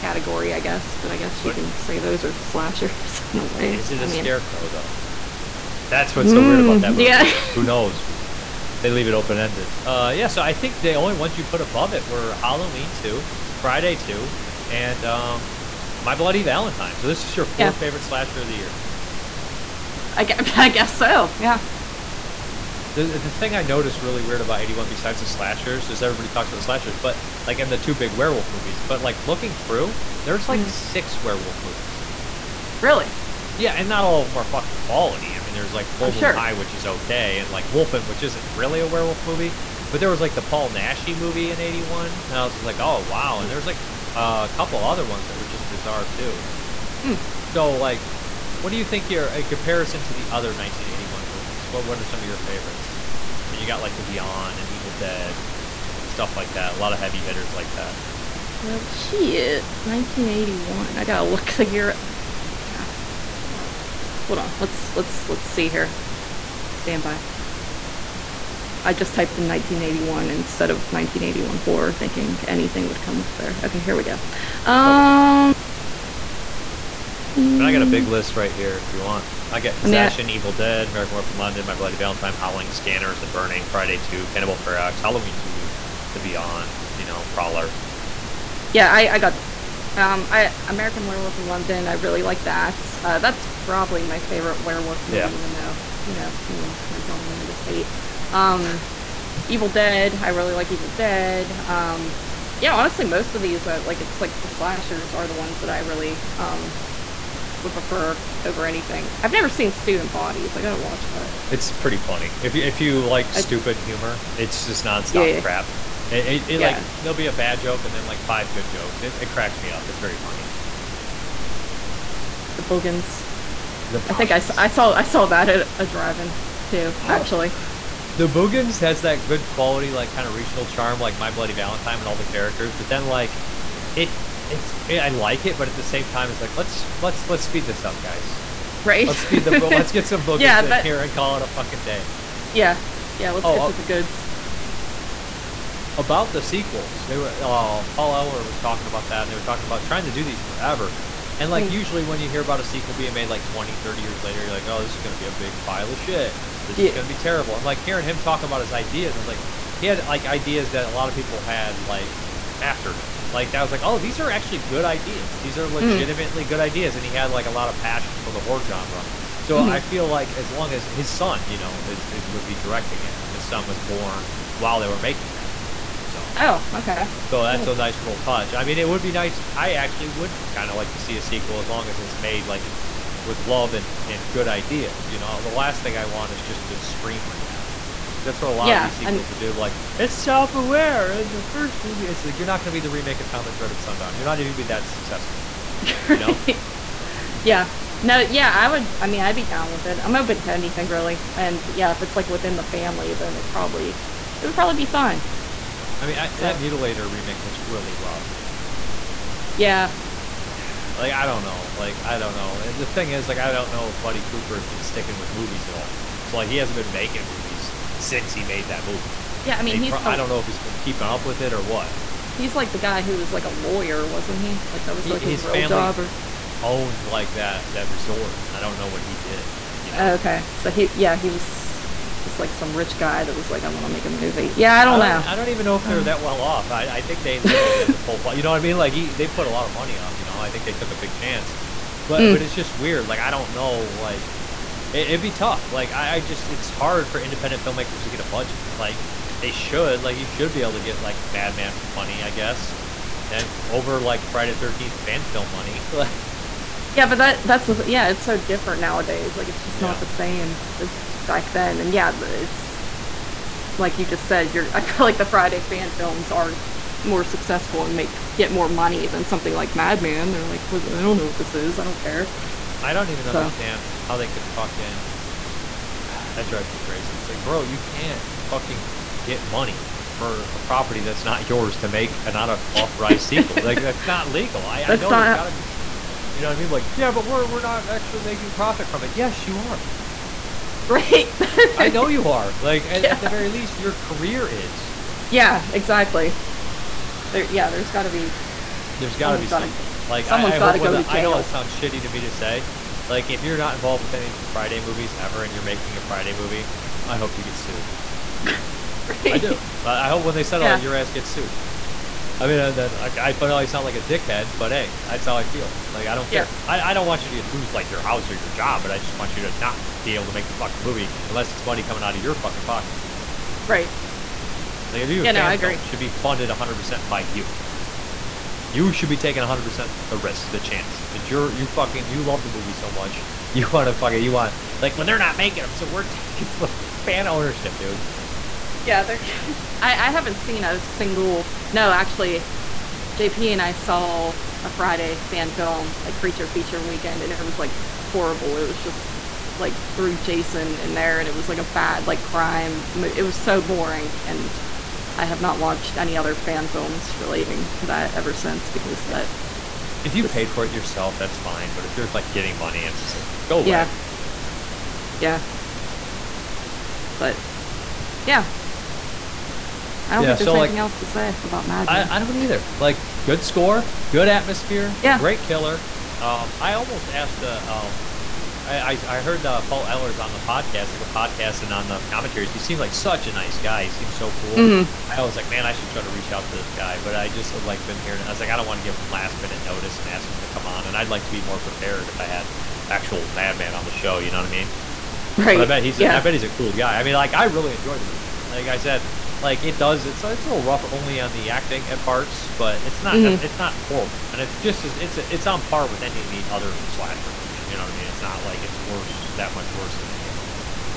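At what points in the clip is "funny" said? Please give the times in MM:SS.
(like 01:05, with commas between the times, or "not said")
01:51, 02:00.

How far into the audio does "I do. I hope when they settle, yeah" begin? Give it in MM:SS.
05:09.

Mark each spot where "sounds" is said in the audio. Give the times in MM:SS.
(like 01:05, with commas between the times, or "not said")
05:01, 05:13.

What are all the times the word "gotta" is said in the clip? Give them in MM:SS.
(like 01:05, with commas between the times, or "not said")
01:01, 01:50, 04:45, 04:59.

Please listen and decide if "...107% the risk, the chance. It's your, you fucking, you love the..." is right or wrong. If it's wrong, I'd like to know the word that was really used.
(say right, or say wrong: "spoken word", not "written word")
wrong: "100", not "107".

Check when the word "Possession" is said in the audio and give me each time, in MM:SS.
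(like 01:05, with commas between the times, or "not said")
01:19.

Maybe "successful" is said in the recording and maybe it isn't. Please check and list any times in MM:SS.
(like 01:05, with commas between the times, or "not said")
03:14, 04:27.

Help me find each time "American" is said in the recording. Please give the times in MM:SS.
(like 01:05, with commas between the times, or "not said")
01:20, 01:30.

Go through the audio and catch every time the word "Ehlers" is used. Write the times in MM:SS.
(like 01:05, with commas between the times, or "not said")
02:27, 06:19.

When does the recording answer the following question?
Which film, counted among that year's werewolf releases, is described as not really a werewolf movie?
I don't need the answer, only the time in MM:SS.
00:37.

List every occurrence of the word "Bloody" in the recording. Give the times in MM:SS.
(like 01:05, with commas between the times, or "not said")
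00:16, 01:21, 02:11.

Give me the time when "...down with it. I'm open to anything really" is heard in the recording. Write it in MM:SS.
03:19.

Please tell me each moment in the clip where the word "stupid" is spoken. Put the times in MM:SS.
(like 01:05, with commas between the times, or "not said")
01:53.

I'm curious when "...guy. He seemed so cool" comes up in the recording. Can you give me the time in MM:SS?
06:23.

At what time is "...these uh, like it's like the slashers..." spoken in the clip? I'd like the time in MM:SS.
01:43.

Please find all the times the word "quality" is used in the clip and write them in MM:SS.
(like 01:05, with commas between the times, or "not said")
00:34, 02:09.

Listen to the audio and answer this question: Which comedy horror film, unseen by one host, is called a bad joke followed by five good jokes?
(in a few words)
Student Bodies.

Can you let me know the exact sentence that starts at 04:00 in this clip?
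You know, I think they took a big chance.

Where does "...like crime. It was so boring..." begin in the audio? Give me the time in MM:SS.
05:52.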